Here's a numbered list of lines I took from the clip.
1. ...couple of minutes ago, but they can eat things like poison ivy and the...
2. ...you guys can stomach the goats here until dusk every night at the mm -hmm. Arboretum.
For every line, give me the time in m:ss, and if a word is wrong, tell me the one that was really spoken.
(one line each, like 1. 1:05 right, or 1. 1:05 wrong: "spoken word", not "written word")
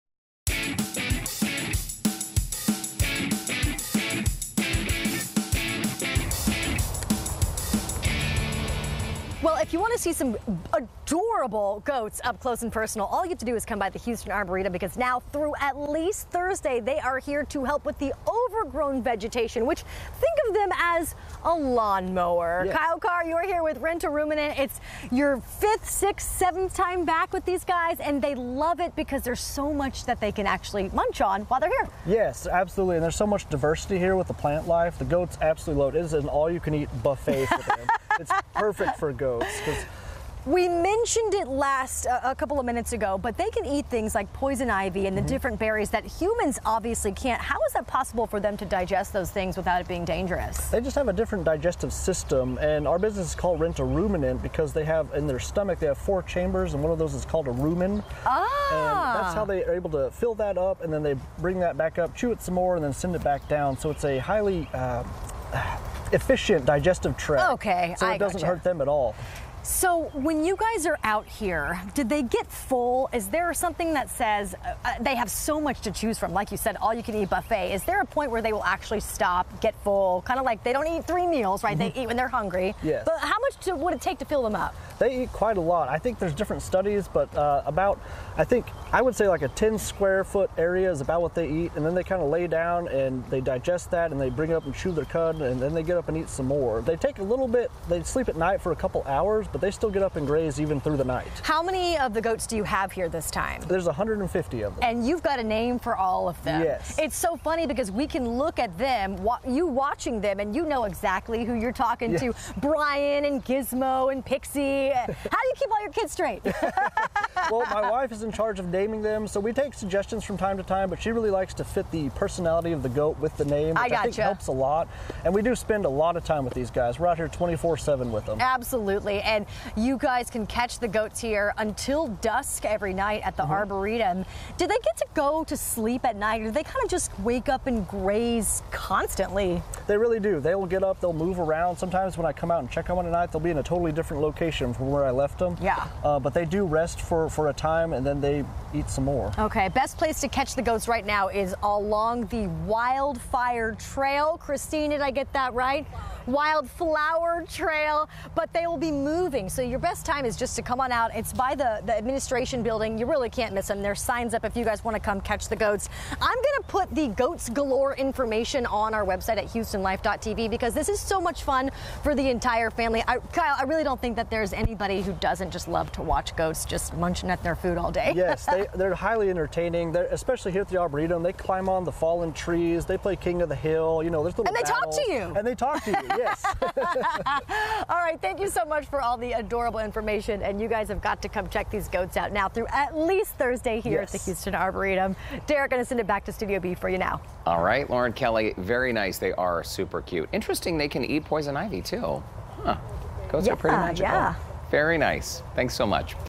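1. 0:42 right
2. 2:09 wrong: "catch", not "stomach".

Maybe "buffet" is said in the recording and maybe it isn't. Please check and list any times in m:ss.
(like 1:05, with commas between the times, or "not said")
0:37, 1:17.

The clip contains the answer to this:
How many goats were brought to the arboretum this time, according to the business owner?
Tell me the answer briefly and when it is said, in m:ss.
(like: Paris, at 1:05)
150, at 1:43.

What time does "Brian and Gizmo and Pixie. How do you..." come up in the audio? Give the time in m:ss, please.
1:52.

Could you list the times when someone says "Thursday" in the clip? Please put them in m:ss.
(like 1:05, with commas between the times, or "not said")
0:16, 3:13.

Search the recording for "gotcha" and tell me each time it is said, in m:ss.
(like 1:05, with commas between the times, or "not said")
1:08, 2:03.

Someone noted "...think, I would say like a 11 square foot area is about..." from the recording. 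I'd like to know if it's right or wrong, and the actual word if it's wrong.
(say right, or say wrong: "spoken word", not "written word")
wrong: "10", not "11".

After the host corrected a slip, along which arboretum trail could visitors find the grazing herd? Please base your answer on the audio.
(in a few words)
Wildflower Trail.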